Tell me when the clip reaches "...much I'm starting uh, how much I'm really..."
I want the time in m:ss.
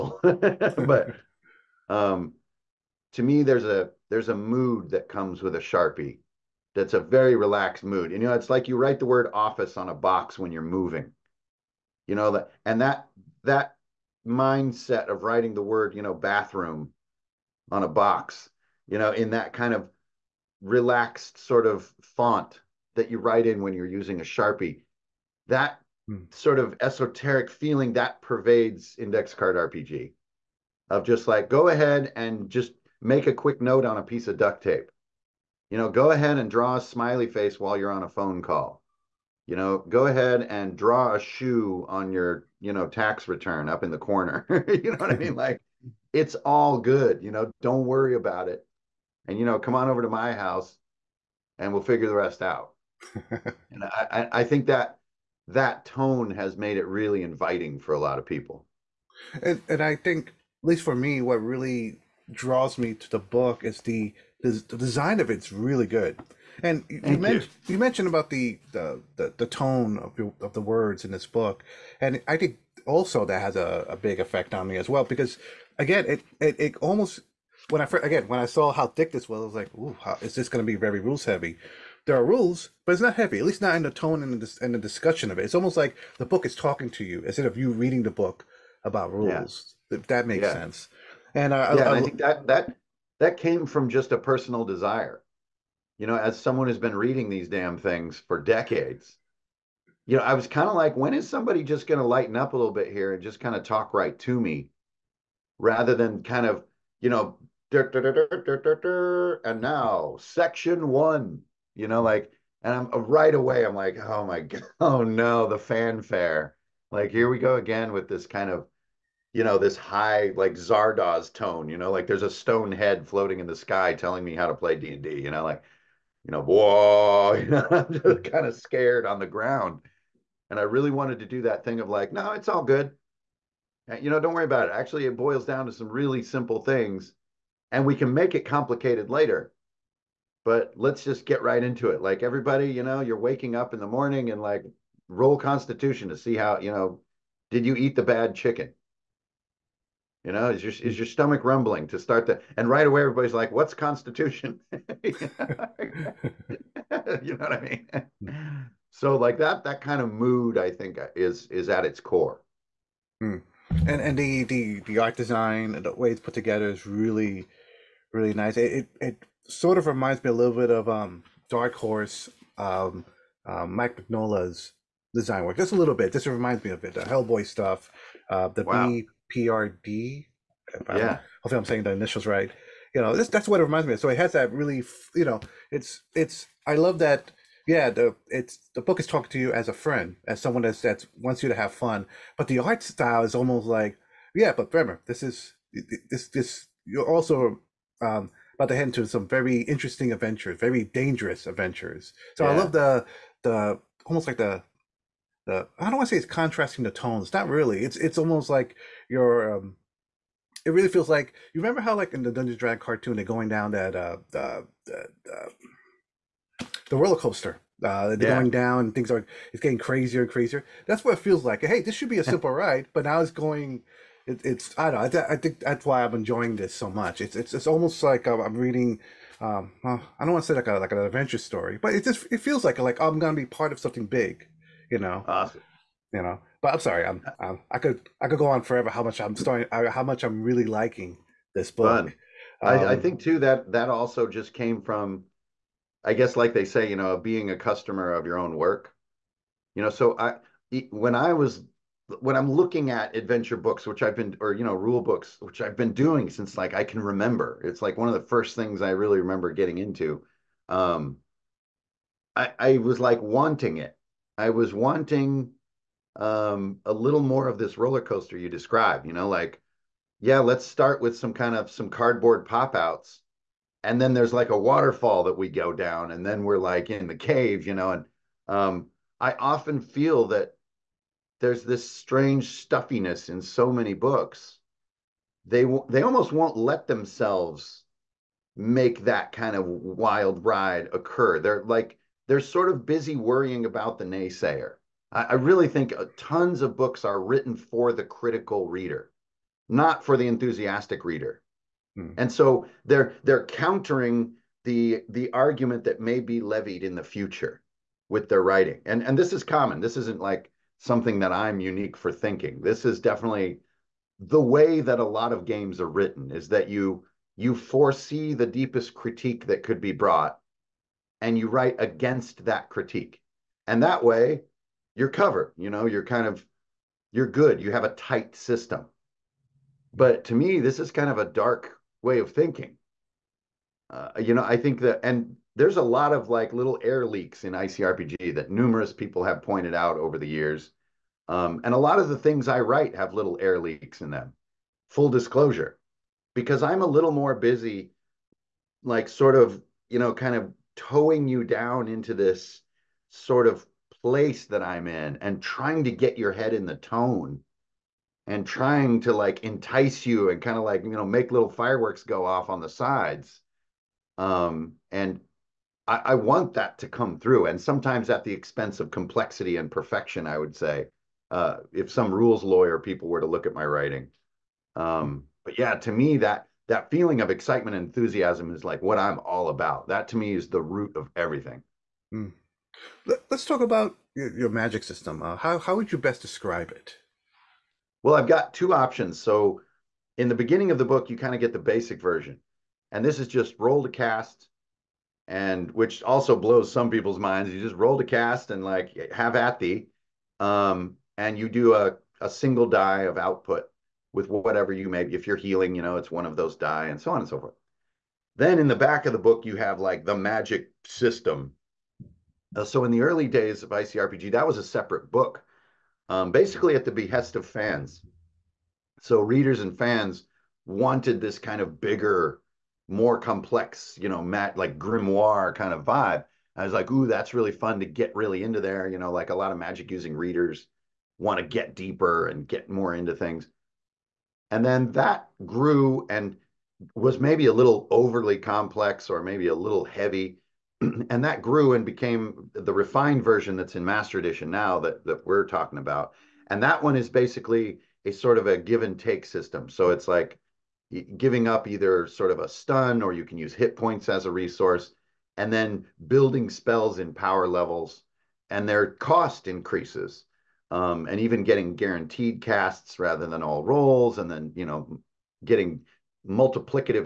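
3:59.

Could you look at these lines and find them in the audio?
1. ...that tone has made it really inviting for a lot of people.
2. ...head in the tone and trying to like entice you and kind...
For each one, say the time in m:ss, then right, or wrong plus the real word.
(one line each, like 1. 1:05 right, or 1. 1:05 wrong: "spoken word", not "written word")
1. 0:55 right
2. 5:56 right.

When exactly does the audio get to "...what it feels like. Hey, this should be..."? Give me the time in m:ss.
3:41.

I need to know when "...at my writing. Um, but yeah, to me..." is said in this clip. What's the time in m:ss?
6:13.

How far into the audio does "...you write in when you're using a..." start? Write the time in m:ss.
0:23.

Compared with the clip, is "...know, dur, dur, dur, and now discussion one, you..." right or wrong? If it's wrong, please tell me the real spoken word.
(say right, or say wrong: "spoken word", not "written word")
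wrong: "section", not "discussion".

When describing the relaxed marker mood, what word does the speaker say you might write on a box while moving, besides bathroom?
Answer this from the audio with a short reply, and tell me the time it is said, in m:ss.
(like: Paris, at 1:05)
office, at 0:09.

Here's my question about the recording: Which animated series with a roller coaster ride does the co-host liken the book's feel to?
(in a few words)
Dungeons Dragon cartoon.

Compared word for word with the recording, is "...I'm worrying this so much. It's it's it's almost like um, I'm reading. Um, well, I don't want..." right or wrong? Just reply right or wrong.
wrong.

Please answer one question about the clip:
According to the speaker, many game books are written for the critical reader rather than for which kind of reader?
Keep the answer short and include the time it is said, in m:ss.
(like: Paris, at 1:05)
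the enthusiastic reader, at 5:00.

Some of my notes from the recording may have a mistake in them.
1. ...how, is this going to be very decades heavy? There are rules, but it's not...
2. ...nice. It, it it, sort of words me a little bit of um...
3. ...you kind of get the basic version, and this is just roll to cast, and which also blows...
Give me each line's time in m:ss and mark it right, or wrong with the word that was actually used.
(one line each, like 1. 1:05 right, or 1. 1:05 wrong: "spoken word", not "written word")
1. 1:19 wrong: "rules", not "decades"
2. 2:48 wrong: "reminds", not "words"
3. 6:31 right.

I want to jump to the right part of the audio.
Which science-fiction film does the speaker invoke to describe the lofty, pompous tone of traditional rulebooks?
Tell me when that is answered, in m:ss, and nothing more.
2:00.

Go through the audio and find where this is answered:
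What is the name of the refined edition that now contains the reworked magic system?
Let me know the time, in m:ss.
7:23.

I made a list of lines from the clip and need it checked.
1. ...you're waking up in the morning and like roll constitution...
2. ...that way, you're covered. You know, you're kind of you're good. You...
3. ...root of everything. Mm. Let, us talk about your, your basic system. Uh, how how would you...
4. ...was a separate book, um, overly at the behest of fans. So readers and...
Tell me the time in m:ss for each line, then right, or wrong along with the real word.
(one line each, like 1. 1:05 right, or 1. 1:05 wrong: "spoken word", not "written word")
1. 2:23 right
2. 5:23 right
3. 6:20 wrong: "magic", not "basic"
4. 6:54 wrong: "basically", not "overly".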